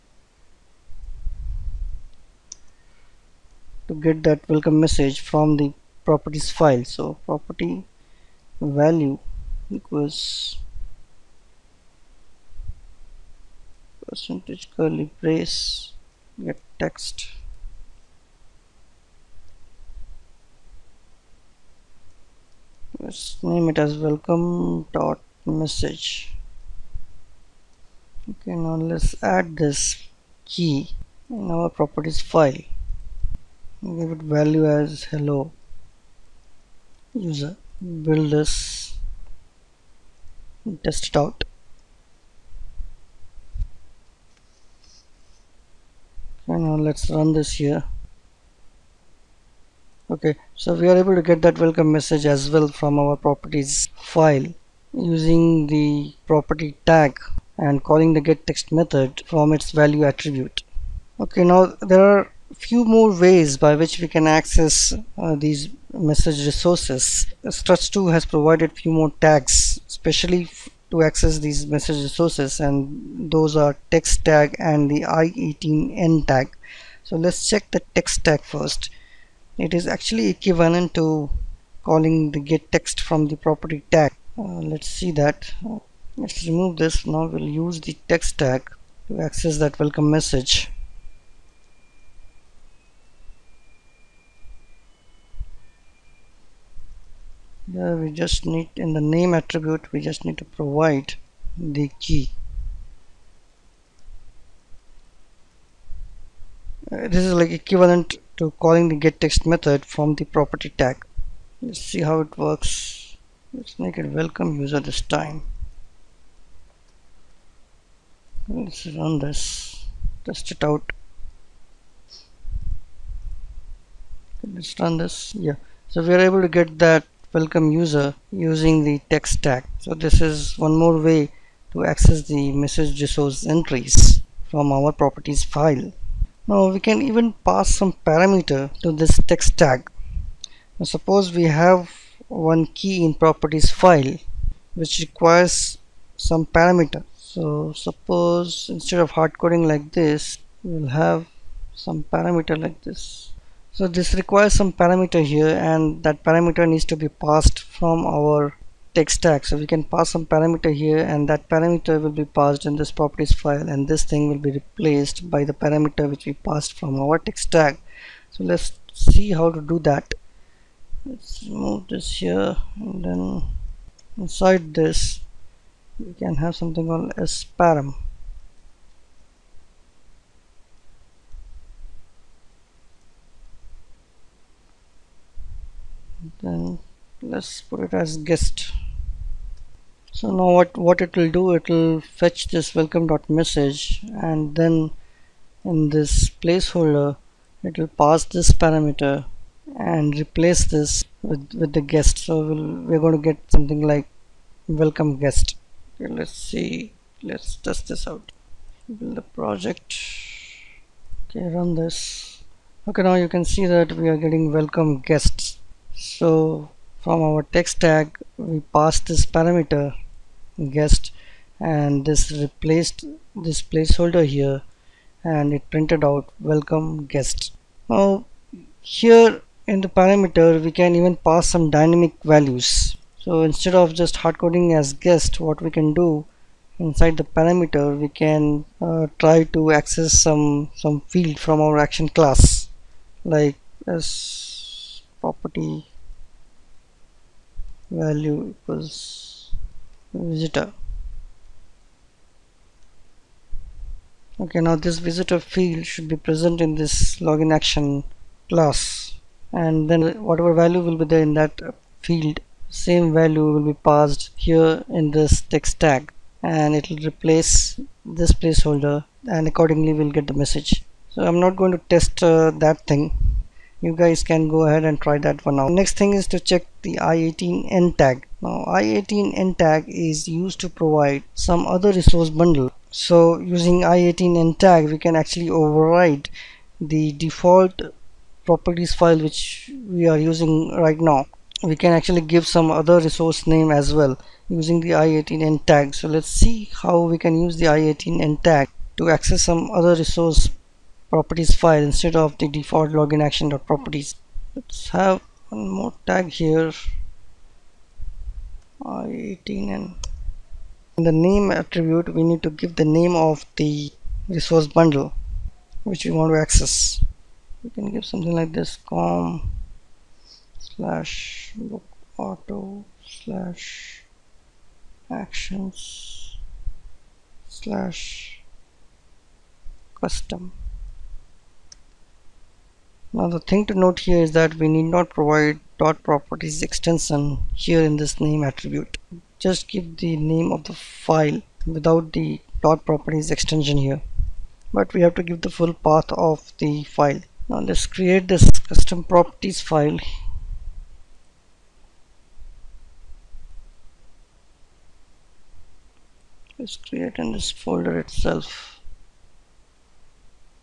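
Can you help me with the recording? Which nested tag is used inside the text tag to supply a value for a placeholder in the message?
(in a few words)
sparam.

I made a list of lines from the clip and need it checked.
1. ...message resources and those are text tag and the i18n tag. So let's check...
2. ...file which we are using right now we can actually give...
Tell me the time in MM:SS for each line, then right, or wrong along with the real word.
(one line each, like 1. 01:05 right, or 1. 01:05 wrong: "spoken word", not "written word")
1. 01:11 right
2. 04:48 right.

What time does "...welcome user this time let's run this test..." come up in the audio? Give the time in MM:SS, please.
01:54.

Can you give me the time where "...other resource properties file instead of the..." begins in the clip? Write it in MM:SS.
04:59.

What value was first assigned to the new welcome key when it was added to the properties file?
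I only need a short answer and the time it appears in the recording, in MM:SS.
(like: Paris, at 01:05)
hello user, at 00:35.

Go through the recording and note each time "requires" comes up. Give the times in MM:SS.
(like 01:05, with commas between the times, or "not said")
02:25, 02:34.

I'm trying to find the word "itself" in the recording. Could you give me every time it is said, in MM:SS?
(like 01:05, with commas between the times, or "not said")
05:58.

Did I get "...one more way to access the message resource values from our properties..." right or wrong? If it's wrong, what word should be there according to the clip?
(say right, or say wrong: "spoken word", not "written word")
wrong: "entries", not "values".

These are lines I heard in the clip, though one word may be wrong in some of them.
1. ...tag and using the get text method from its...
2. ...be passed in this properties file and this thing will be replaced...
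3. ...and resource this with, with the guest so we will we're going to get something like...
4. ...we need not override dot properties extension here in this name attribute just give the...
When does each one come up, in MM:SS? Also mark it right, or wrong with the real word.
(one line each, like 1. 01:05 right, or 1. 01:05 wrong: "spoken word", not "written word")
1. 00:56 wrong: "calling", not "using"
2. 02:42 right
3. 03:19 wrong: "replace", not "resource"
4. 05:34 wrong: "provide", not "override".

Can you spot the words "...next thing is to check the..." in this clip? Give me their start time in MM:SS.
04:35.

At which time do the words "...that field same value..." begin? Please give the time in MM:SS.
04:21.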